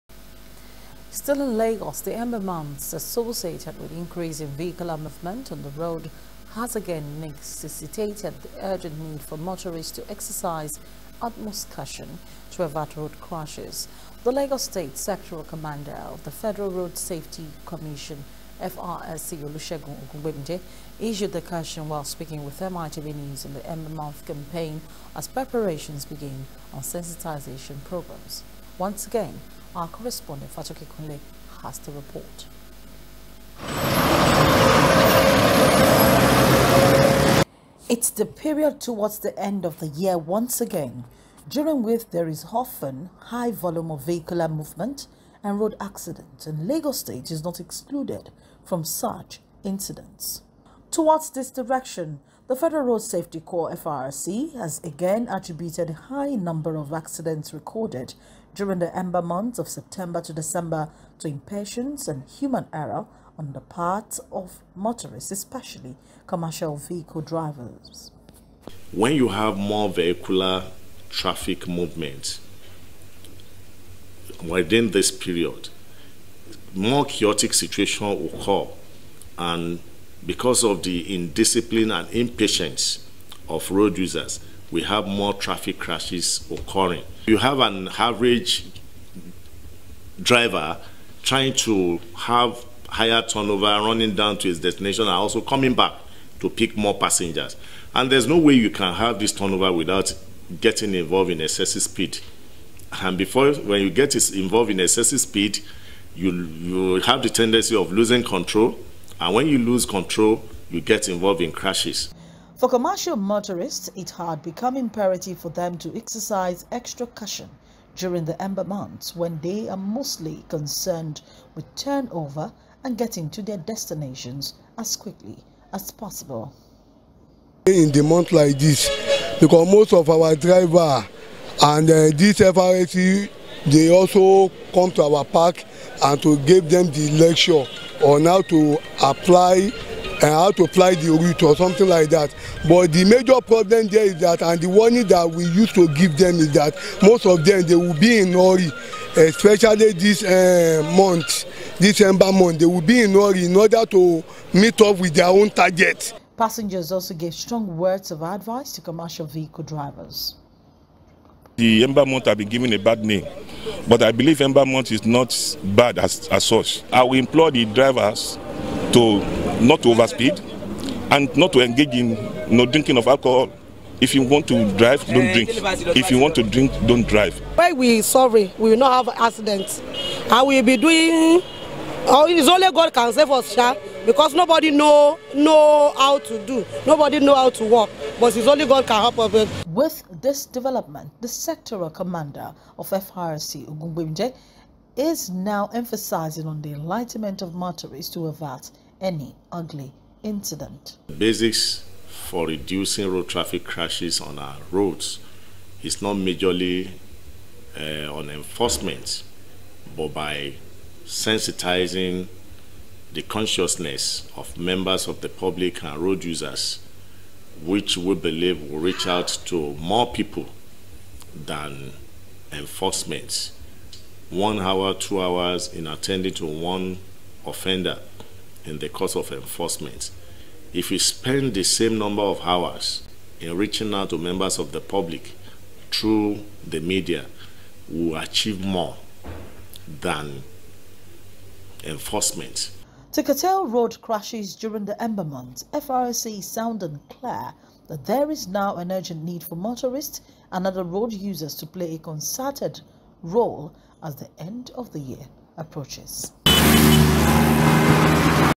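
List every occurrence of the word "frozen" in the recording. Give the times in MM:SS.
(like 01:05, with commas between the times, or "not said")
not said.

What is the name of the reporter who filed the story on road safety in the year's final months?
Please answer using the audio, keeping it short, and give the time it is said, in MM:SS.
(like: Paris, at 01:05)
Fatoki Kunle, at 00:30.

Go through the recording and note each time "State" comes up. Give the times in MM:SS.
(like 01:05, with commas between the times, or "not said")
00:14, 00:46.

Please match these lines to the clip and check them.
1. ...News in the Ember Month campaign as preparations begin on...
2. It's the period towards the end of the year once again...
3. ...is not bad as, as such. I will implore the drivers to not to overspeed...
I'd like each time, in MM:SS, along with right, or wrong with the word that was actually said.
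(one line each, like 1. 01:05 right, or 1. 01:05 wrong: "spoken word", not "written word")
1. 00:23 right
2. 00:37 right
3. 02:44 right.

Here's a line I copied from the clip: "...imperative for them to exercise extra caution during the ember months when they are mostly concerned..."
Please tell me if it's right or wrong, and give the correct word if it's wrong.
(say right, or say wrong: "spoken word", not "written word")
right.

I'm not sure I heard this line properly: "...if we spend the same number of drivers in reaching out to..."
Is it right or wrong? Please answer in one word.
wrong.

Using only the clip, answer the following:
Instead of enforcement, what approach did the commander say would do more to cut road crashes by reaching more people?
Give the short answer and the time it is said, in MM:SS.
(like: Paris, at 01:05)
sensitizing, at 03:31.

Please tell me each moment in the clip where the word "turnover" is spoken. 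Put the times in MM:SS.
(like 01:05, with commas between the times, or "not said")
01:33, 01:39, 02:01.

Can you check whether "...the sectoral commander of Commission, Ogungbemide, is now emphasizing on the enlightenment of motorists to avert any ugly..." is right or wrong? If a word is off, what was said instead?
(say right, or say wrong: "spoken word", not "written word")
wrong: "FRC", not "Commission".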